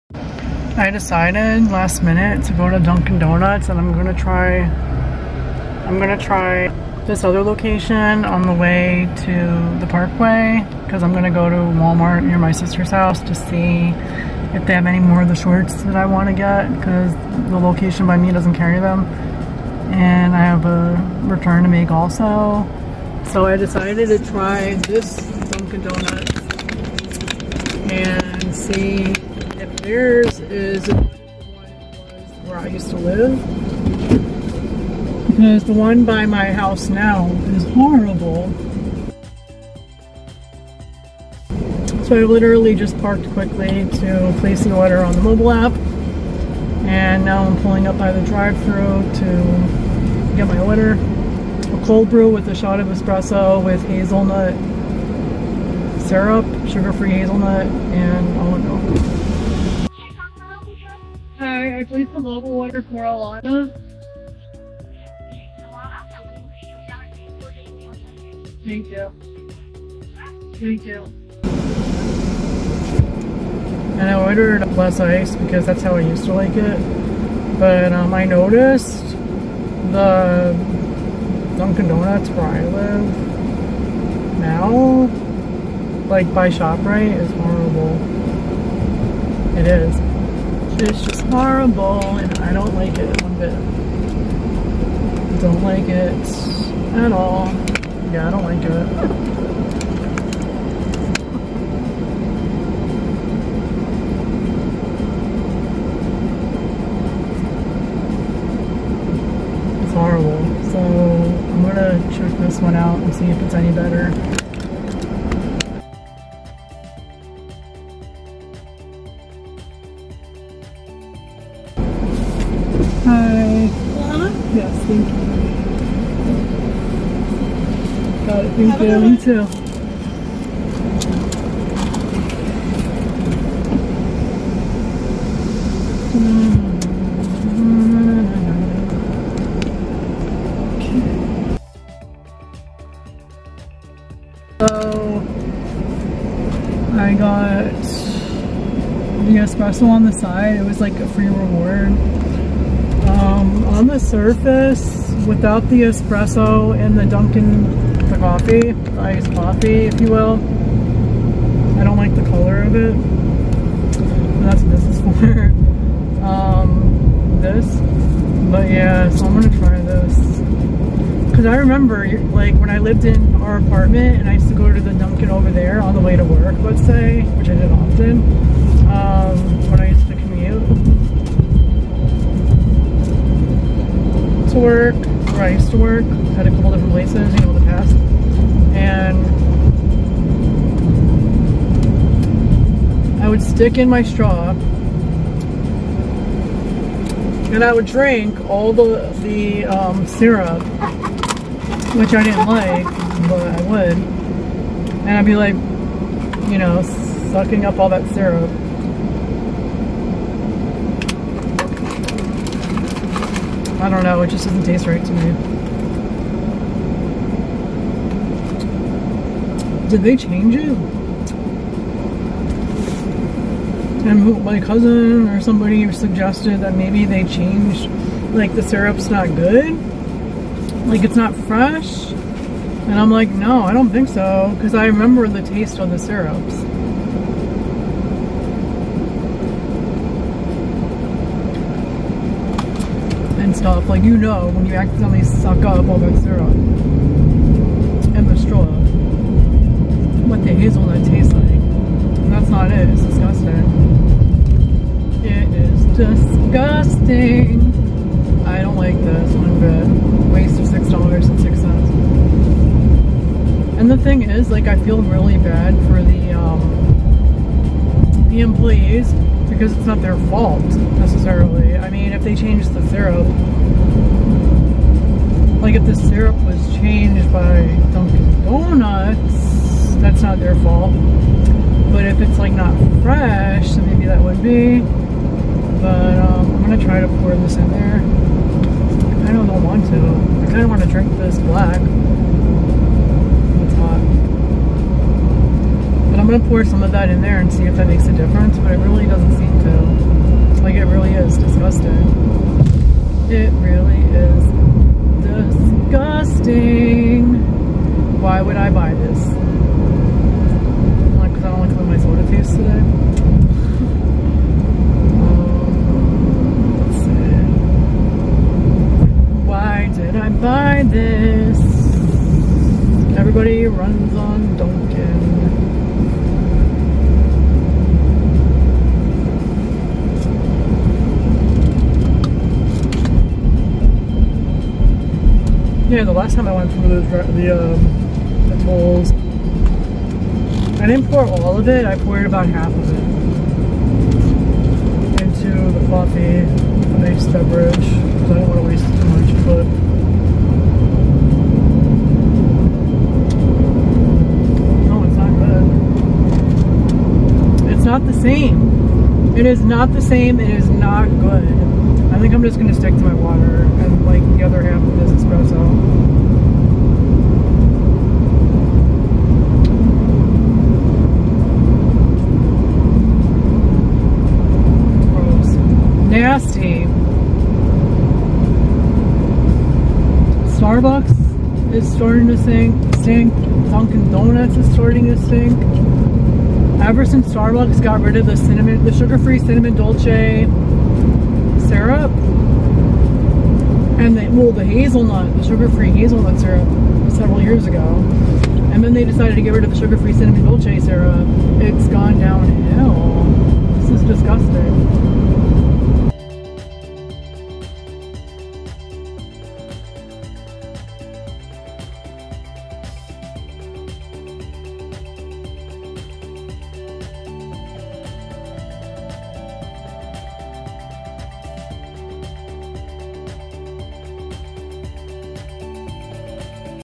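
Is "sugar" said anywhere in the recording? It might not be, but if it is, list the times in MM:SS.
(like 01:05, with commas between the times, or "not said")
00:56, 06:28, 06:35, 06:39.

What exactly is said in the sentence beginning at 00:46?
And now I'm pulling up by the drive-through to get my order.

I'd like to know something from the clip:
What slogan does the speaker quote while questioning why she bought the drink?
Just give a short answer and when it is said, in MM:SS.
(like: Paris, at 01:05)
Everybody runs on donuts, at 05:23.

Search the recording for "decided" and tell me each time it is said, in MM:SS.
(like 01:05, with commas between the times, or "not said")
00:00, 00:23, 06:39.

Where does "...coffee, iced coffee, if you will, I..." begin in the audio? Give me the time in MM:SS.
02:38.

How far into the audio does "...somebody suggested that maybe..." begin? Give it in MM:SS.
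03:45.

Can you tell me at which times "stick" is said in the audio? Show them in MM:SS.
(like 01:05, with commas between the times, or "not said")
03:13, 06:02.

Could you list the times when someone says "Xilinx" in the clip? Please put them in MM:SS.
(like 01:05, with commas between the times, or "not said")
not said.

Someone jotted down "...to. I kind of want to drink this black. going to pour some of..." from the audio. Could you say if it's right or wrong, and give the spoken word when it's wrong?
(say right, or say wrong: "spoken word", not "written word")
right.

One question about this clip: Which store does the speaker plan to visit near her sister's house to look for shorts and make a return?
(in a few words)
Walmart.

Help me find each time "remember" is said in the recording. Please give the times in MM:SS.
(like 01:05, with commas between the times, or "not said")
02:51, 03:54.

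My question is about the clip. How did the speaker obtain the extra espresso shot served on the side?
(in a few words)
free reward.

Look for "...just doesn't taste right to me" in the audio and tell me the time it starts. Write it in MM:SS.
03:34.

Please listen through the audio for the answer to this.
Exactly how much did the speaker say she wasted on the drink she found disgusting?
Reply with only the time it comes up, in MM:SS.
04:20.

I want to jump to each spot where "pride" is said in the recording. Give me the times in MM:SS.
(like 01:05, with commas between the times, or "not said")
not said.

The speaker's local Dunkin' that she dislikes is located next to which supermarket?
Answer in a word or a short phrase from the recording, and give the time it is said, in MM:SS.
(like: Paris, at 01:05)
ShopRite, at 01:26.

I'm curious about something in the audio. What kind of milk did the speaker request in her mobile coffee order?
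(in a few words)
almond milk.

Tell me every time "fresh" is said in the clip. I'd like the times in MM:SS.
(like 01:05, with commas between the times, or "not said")
03:51, 04:43.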